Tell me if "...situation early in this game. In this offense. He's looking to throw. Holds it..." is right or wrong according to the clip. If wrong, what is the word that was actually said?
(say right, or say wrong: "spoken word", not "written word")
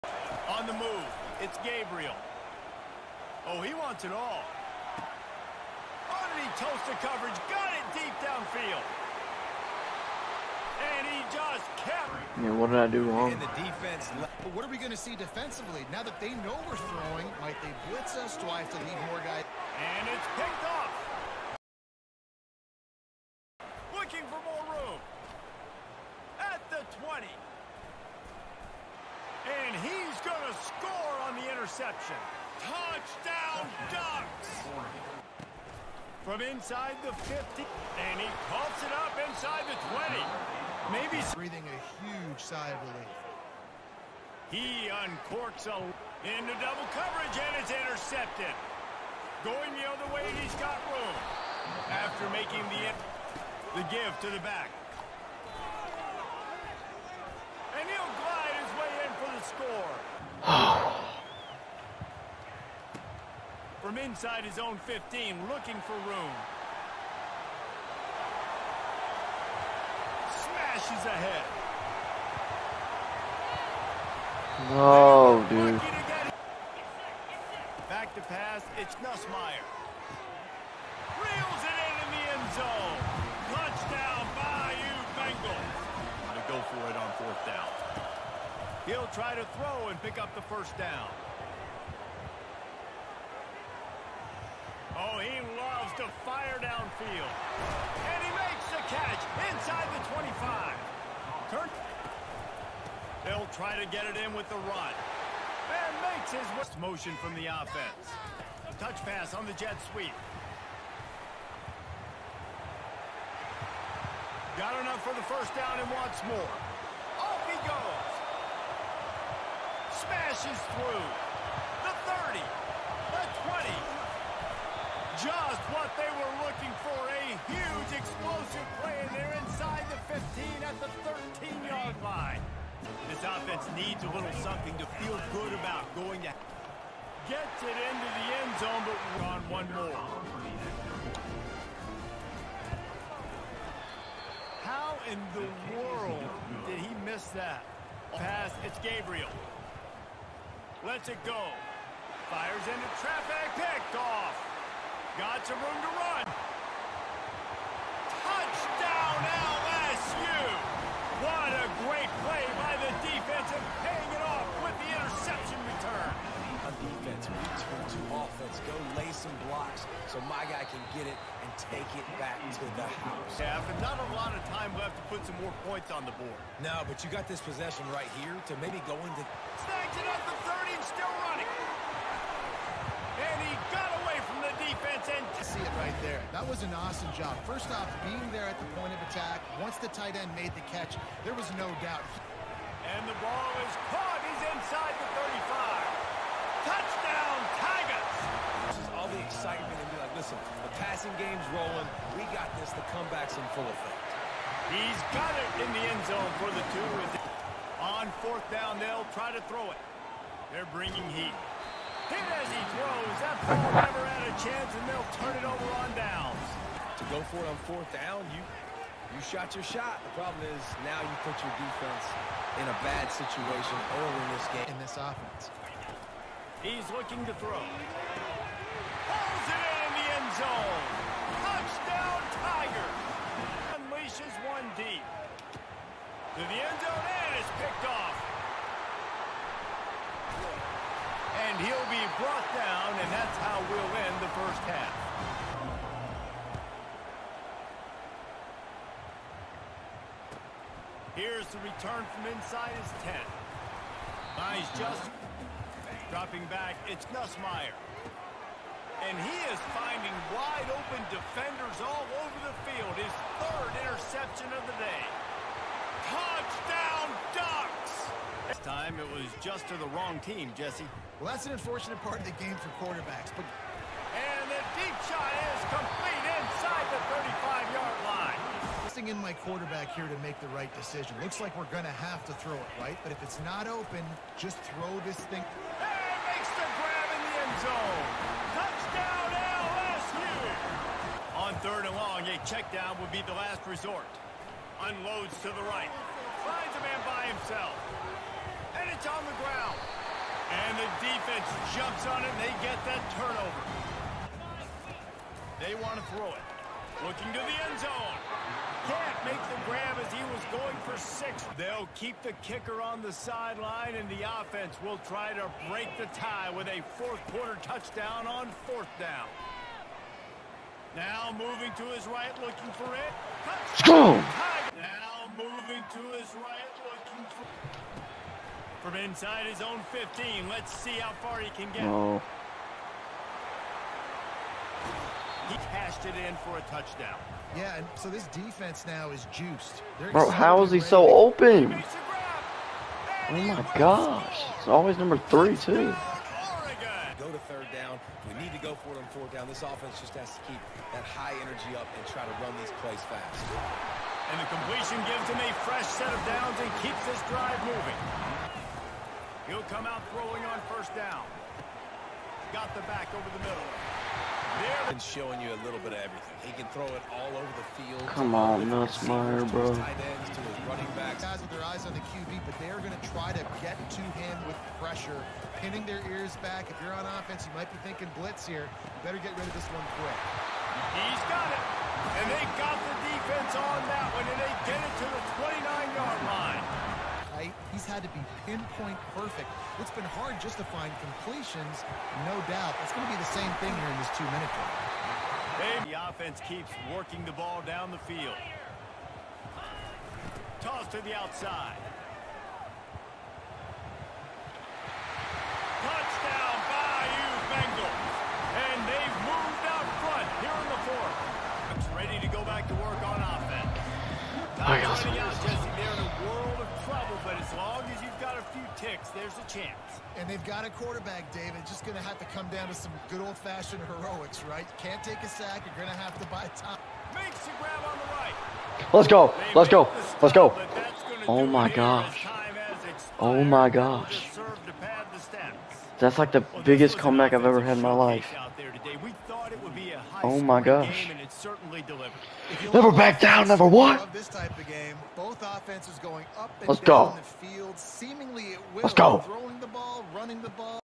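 right.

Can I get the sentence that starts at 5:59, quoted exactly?
He'll come out throwing on first down.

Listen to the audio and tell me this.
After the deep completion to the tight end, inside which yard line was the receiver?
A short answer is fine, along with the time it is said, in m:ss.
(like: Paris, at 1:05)
35, at 3:15.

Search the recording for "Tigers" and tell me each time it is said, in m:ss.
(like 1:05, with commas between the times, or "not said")
3:17, 3:52.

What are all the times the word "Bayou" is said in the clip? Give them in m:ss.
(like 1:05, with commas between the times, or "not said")
1:24, 6:46.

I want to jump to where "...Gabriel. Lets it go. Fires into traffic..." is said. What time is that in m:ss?
2:28.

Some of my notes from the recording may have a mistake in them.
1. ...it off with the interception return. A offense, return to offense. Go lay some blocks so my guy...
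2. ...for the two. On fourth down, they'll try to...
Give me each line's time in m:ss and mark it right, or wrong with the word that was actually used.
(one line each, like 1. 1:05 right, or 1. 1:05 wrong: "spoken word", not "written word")
1. 2:44 wrong: "defense", not "offense"
2. 3:26 right.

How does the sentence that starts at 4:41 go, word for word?
Looks like we're going to have to throw it, right?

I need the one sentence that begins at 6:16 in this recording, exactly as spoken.
If you're on offense, you might be thinking blitz here.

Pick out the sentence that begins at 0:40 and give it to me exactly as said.
Maybe breathing a huge sigh of relief.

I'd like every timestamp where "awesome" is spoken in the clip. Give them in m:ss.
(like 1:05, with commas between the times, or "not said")
3:06.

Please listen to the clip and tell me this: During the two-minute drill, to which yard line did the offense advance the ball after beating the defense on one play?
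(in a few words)
29-yard line.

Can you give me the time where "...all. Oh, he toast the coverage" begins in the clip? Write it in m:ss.
0:04.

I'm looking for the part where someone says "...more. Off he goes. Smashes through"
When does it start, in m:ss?
1:56.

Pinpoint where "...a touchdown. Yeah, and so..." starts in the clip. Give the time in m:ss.
5:36.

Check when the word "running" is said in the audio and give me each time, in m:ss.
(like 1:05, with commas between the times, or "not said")
6:10, 7:30.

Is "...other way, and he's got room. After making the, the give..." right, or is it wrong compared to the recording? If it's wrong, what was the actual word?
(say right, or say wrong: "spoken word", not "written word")
right.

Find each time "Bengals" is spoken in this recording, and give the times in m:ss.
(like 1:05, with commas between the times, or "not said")
1:25, 6:47.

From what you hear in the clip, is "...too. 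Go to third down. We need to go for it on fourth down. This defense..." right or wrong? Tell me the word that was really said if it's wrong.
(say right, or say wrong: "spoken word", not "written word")
wrong: "offense", not "defense".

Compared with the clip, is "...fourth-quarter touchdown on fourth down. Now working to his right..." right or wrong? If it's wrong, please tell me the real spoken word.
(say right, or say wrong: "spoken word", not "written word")
wrong: "moving", not "working".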